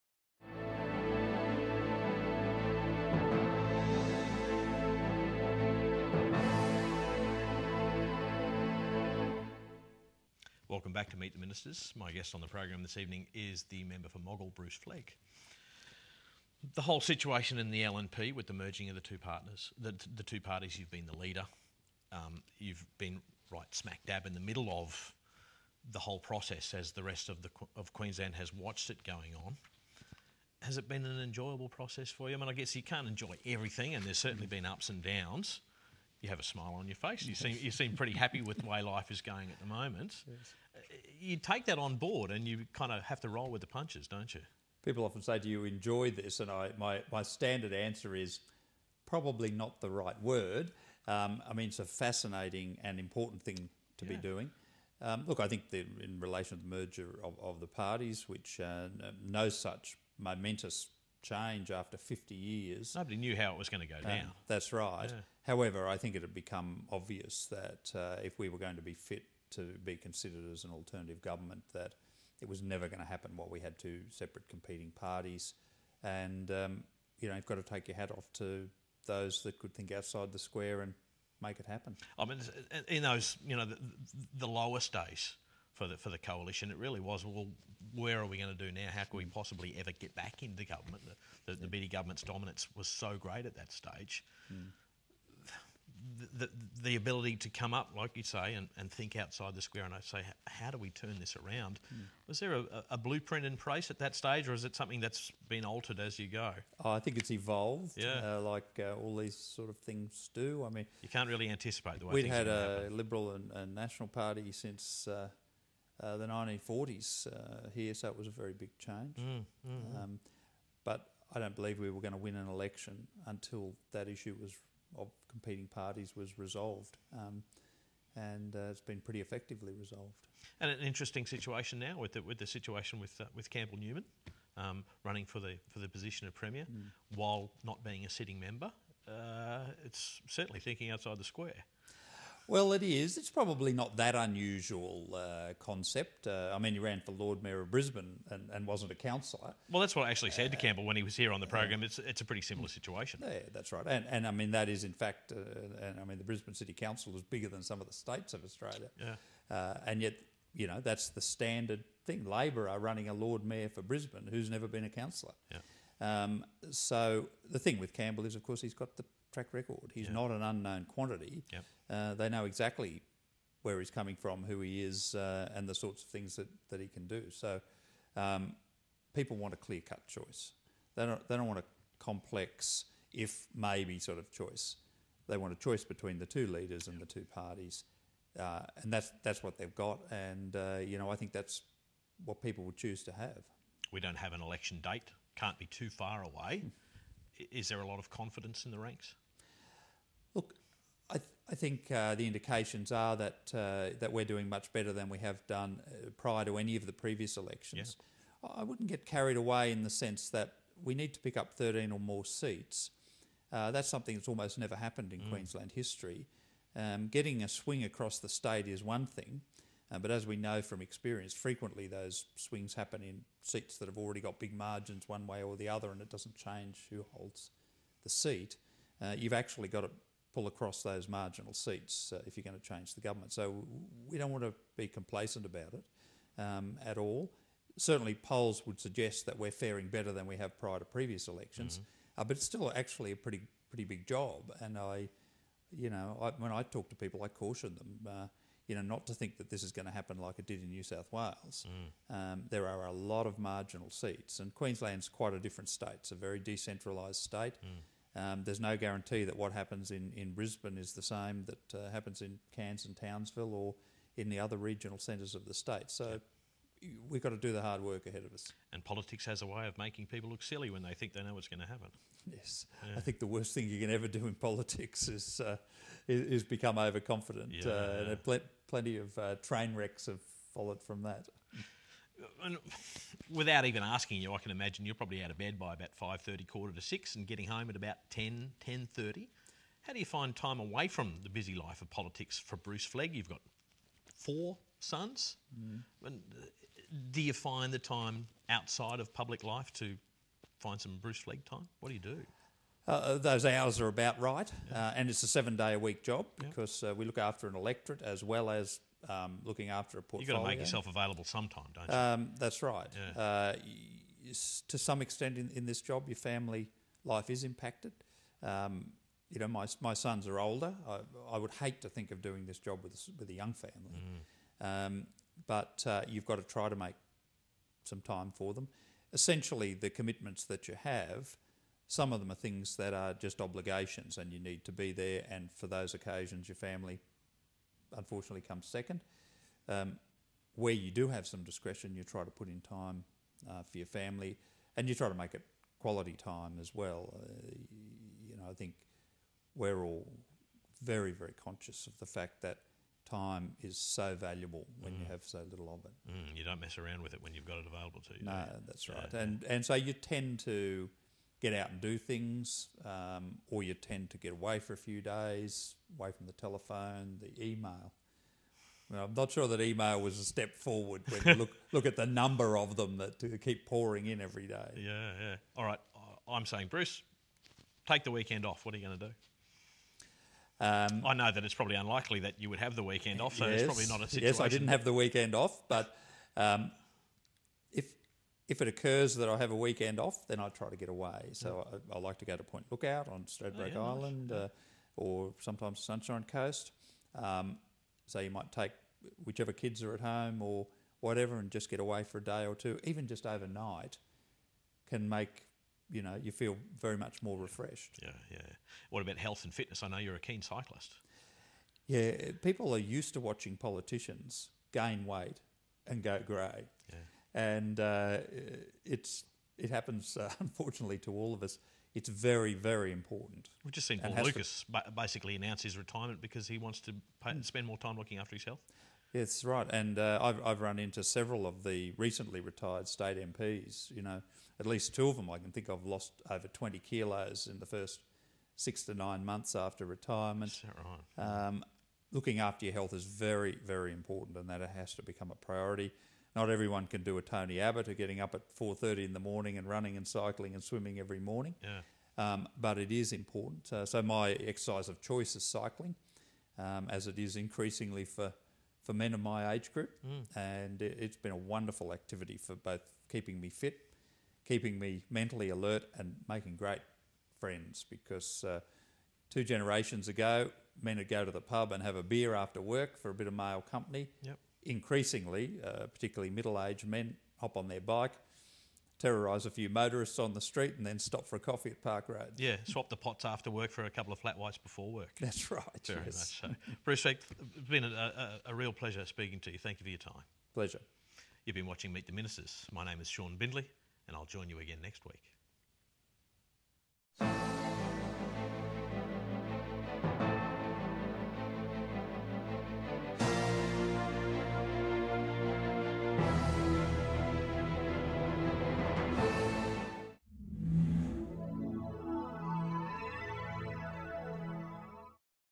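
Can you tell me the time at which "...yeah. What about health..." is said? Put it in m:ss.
6:48.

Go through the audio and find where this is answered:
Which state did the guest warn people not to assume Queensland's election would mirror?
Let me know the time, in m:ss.
4:10.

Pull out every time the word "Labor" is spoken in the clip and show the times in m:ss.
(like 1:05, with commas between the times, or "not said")
2:42.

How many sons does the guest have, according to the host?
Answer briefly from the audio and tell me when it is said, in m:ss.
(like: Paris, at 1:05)
4, at 4:54.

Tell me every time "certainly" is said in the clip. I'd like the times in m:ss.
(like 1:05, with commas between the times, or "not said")
0:34, 2:20, 3:57.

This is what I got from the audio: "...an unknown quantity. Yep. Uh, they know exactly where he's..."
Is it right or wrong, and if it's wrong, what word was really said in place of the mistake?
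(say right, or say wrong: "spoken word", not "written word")
right.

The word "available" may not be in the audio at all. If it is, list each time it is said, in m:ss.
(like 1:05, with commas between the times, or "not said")
5:10, 5:57.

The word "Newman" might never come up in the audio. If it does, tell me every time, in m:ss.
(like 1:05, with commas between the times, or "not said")
2:13.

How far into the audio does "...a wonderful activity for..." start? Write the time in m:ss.
7:41.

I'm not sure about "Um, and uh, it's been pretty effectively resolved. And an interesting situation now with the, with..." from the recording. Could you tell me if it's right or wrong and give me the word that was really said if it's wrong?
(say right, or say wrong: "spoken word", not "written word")
right.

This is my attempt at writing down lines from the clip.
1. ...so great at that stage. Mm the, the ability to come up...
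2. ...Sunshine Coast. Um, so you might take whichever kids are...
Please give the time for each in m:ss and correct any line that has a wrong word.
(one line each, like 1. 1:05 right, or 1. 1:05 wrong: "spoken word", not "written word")
1. 1:32 right
2. 6:35 right.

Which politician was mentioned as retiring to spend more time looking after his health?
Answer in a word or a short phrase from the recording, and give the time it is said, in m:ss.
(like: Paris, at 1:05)
Paul Lucas, at 7:03.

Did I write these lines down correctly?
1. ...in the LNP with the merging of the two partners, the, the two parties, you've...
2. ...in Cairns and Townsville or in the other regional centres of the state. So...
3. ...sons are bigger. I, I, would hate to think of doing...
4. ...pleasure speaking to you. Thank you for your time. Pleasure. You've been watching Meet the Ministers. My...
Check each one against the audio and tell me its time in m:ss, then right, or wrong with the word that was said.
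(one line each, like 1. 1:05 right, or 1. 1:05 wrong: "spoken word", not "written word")
1. 0:17 right
2. 4:22 right
3. 5:19 wrong: "older", not "bigger"
4. 8:08 right.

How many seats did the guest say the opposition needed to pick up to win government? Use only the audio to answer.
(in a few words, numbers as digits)
13.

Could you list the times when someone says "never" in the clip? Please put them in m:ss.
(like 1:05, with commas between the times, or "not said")
1:12, 2:44, 3:34.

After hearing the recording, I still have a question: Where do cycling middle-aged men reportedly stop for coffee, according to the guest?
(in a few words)
Park Road.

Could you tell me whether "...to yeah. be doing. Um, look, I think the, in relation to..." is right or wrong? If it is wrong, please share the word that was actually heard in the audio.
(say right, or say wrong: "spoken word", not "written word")
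right.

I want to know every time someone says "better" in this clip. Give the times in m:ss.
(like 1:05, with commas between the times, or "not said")
3:24, 3:59.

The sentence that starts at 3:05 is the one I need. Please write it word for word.
They want a choice between the two leaders and yep.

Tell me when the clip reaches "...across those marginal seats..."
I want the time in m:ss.
3:50.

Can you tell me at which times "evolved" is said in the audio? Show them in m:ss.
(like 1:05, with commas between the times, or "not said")
1:47.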